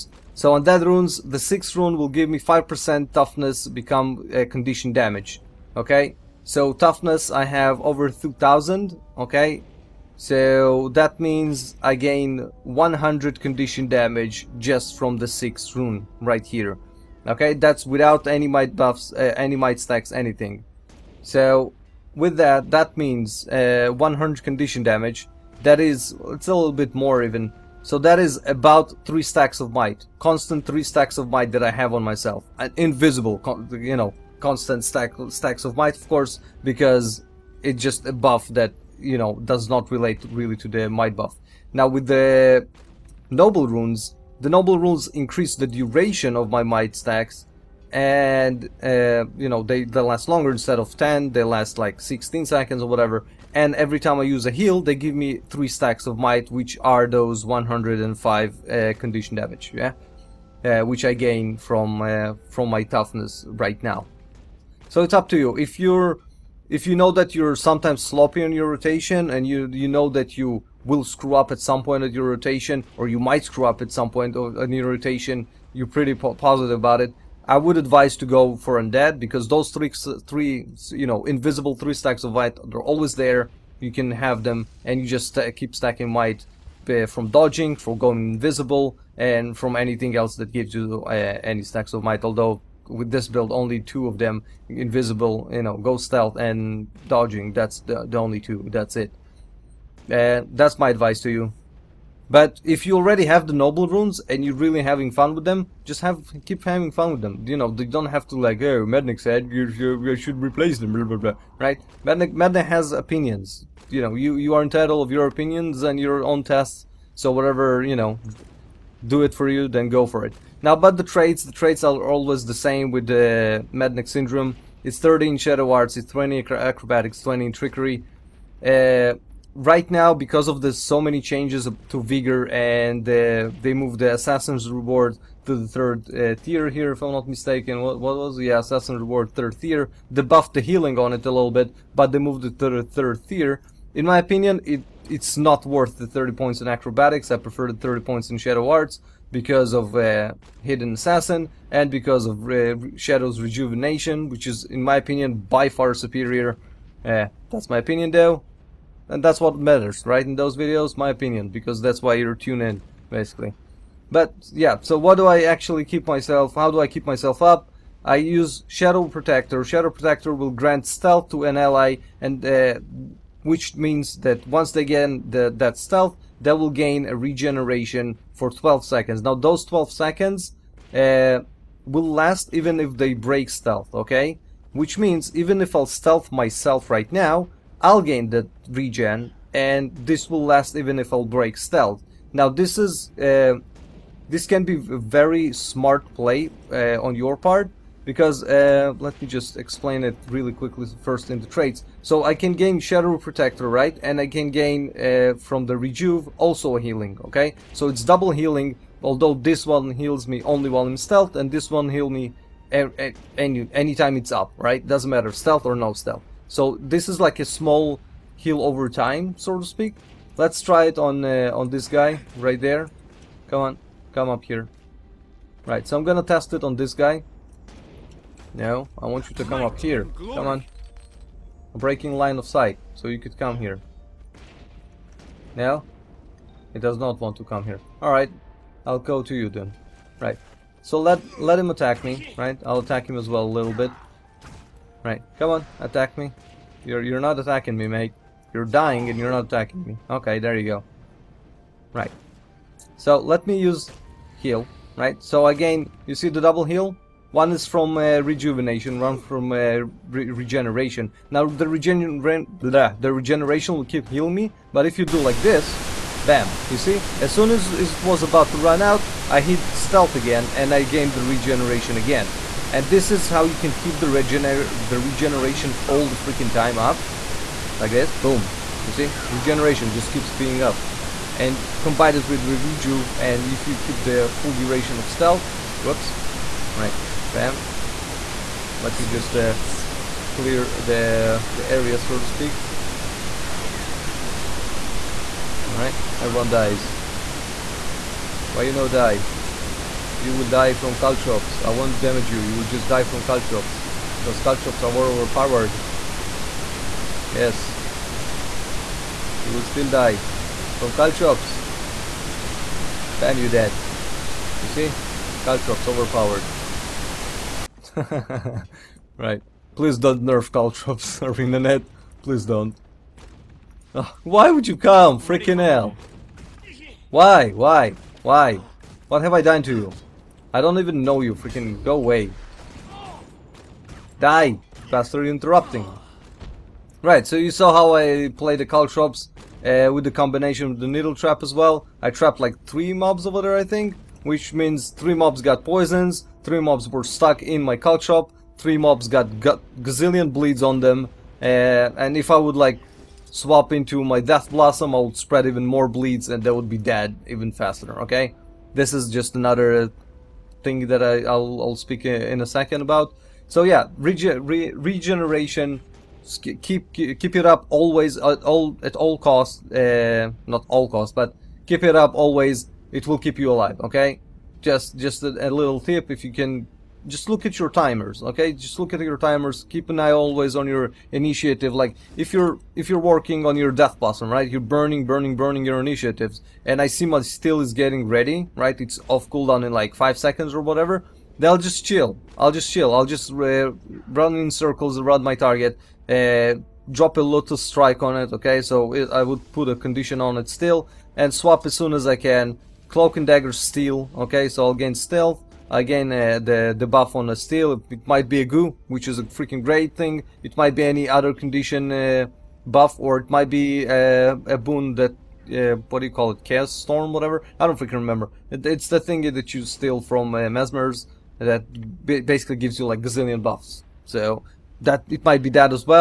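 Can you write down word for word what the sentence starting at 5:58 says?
This is just another thing that I, will I'll speak in a second about.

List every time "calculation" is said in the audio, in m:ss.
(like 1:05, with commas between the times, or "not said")
not said.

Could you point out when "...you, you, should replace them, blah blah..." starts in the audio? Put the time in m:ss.
1:49.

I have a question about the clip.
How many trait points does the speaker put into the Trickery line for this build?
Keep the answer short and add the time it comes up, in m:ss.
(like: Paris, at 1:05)
20, at 2:07.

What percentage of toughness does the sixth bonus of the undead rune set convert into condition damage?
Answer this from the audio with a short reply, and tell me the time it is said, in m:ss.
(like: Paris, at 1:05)
5%, at 0:02.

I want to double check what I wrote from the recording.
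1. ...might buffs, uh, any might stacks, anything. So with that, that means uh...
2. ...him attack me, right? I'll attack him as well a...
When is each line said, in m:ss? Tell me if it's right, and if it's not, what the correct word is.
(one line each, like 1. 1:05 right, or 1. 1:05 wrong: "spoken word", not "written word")
1. 0:18 right
2. 4:01 right.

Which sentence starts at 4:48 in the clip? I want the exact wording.
let's just uh, clear the, the area, so to speak.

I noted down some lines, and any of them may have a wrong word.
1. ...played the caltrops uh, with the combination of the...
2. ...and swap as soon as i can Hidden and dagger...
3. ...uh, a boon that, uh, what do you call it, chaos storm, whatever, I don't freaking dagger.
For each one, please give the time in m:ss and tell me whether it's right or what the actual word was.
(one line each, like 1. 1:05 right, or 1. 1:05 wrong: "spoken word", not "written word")
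1. 5:38 right
2. 6:41 wrong: "Cloak", not "Hidden"
3. 6:53 wrong: "remember", not "dagger".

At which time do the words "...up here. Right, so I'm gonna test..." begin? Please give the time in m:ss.
3:44.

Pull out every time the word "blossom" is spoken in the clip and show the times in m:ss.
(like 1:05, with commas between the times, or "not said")
5:54, 6:23.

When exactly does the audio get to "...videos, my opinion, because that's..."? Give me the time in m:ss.
2:40.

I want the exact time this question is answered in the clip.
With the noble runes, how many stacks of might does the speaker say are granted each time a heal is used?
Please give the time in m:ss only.
0:54.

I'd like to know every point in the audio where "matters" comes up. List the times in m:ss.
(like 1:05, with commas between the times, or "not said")
2:39, 3:35.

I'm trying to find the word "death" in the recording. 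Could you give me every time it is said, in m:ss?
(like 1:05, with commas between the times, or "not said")
5:54, 6:23.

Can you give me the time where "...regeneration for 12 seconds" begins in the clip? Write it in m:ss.
2:57.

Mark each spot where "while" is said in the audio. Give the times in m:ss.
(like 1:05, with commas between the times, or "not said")
3:30.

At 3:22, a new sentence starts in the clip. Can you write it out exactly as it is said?
So I can gain Shadow Protector, right?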